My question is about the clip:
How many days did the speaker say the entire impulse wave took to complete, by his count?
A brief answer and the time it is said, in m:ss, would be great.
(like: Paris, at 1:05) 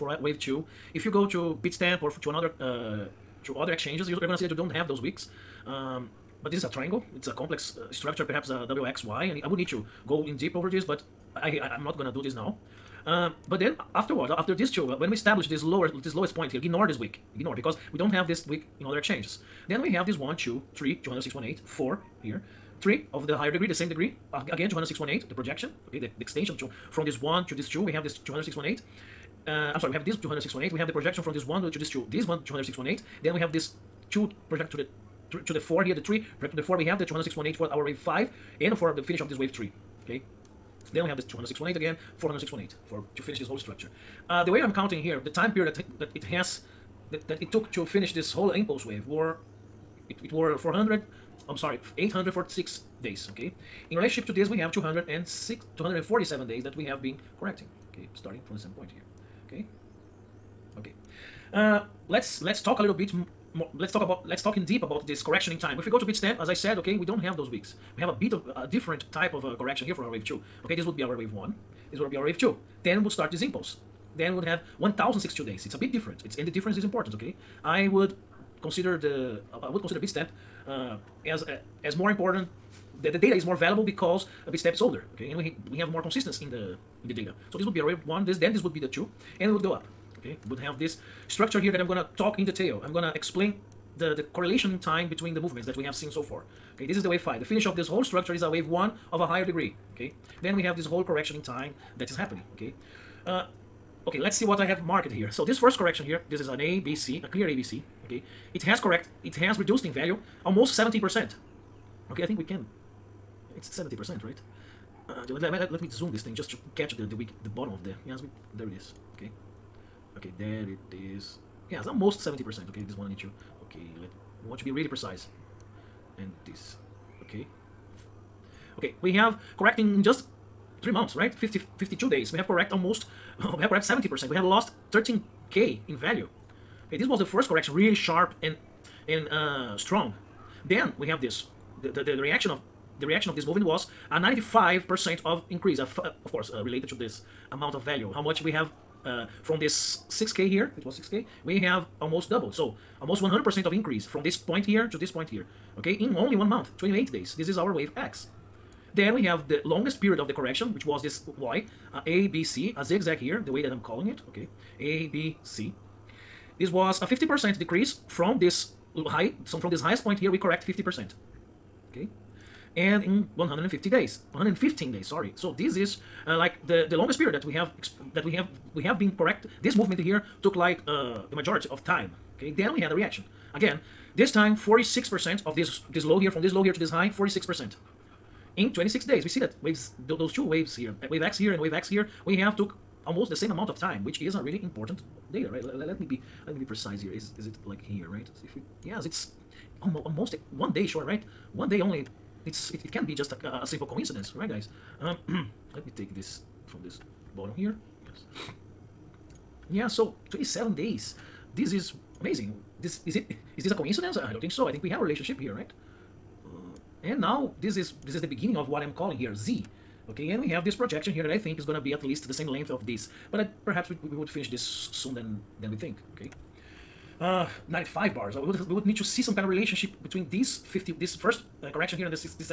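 846 days, at 0:51.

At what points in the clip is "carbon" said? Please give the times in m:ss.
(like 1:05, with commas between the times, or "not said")
not said.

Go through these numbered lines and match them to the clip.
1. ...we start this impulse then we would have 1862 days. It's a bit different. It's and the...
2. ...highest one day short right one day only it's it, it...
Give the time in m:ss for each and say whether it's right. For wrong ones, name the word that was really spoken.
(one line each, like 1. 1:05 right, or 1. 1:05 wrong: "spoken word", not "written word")
1. 1:13 wrong: "1062", not "1862"
2. 3:20 wrong: "almost", not "highest".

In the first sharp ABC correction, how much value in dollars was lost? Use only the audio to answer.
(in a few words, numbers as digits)
13k.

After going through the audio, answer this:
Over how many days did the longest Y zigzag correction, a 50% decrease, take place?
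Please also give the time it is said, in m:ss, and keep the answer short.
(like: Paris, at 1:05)
115 days, at 2:54.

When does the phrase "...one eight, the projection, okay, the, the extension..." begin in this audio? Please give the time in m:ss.
0:24.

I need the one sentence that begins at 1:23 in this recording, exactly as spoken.
The, the data is more valuable because Bitstamp is older, okay?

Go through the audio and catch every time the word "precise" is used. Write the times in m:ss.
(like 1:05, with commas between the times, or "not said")
2:04, 3:16.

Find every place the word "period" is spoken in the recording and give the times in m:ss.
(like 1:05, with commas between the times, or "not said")
0:45, 2:40, 2:57.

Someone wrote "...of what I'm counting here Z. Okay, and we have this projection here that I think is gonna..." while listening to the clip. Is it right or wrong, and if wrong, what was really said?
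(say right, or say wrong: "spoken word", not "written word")
wrong: "calling", not "counting".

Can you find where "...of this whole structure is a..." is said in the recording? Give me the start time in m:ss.
1:37.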